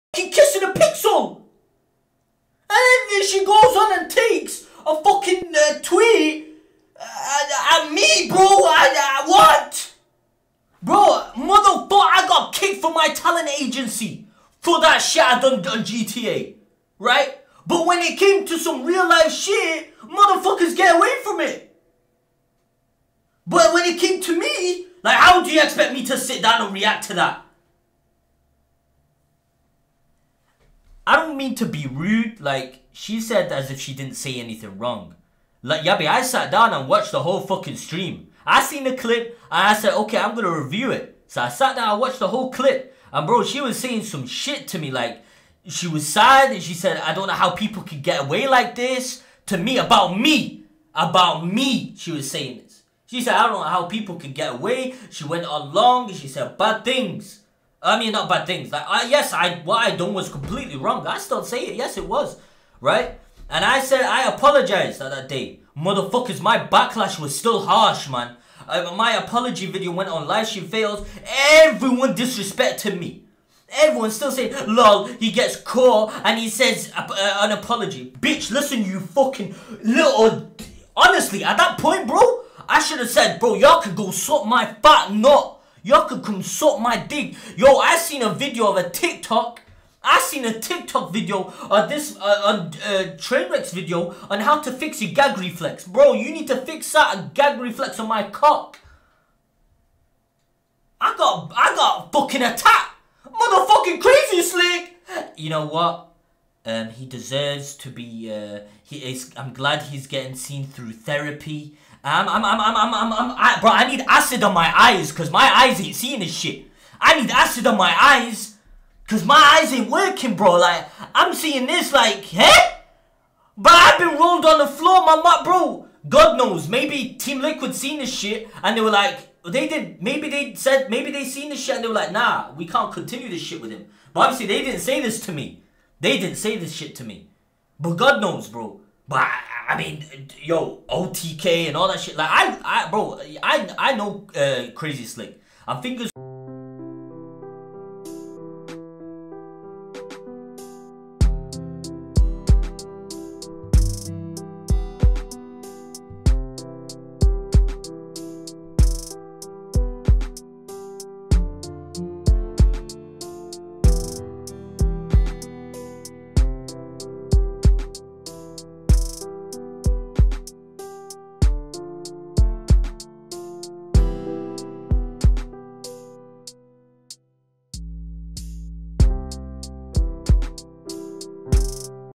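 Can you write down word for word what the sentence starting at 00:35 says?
Like, yeah, I sat down and watched the whole fucking stream.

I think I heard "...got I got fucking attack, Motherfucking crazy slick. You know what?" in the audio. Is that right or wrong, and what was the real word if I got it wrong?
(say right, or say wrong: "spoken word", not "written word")
right.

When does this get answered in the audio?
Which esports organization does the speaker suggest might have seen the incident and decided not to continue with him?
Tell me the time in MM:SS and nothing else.
02:07.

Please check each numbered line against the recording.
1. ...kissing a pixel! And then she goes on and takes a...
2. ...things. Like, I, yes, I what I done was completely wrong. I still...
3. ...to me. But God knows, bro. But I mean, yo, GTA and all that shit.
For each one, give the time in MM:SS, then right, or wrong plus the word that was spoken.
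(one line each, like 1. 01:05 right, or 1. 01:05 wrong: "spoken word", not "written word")
1. 00:00 right
2. 00:58 right
3. 02:16 wrong: "OTK", not "GTA".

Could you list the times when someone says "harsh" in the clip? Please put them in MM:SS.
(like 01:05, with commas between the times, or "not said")
01:07.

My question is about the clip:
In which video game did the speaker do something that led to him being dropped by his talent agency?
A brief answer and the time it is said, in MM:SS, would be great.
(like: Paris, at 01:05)
GTA, at 00:15.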